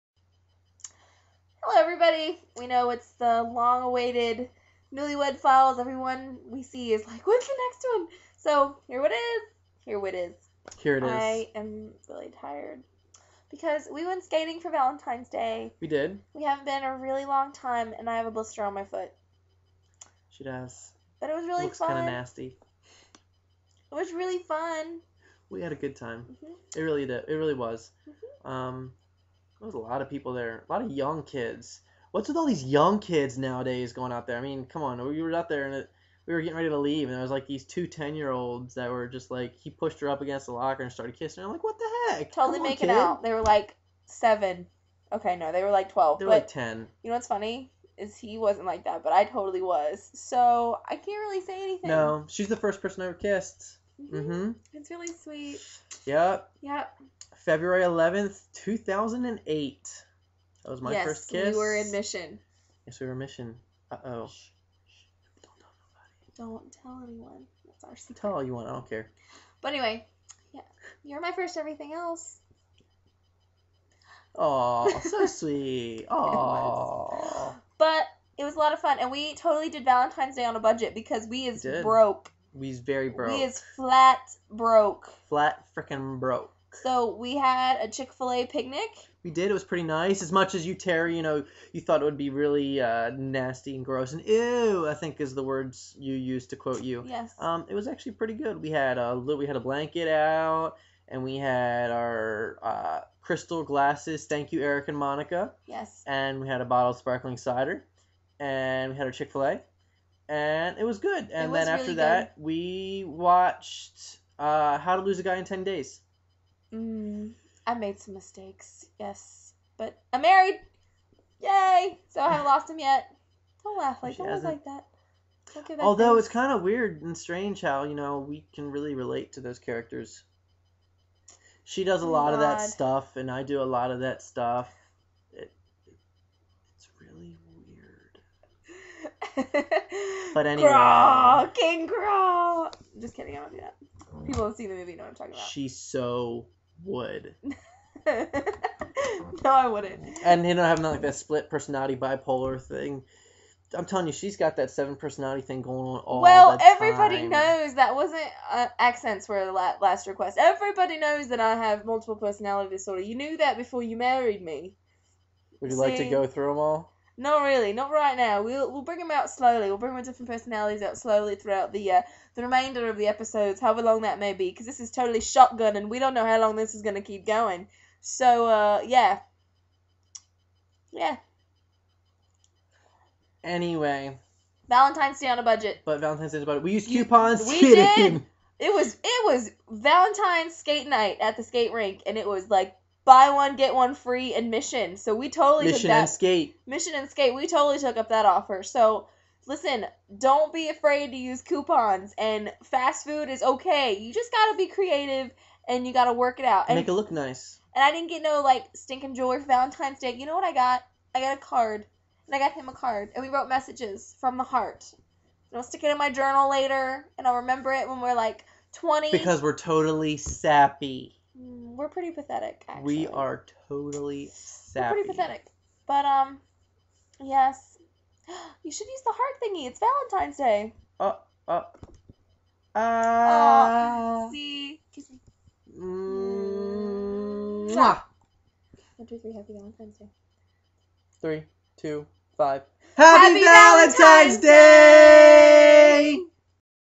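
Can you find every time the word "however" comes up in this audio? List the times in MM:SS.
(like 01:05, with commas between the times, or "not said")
02:53.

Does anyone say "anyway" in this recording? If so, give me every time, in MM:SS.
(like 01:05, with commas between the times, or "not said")
01:09, 02:20, 03:03.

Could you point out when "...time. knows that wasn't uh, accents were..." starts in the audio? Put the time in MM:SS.
02:37.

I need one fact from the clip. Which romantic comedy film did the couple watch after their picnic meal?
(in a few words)
How to Lose a Guy in Ten Days.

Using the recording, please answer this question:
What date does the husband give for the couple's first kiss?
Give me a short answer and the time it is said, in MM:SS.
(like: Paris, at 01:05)
February 11th, 2008, at 00:57.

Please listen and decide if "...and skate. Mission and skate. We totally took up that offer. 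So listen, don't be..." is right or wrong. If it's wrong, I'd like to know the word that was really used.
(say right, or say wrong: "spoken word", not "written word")
right.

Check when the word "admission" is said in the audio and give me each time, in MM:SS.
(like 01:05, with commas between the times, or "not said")
03:14.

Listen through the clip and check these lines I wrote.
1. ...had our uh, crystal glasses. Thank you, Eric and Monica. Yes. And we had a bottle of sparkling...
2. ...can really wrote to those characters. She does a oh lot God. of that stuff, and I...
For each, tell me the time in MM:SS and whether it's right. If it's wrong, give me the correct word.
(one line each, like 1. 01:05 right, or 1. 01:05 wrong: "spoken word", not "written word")
1. 01:41 right
2. 02:08 wrong: "relate", not "wrote".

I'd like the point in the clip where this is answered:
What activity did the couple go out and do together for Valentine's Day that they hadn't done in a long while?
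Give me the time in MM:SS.
00:14.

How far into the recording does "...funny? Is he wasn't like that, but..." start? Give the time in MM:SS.
00:47.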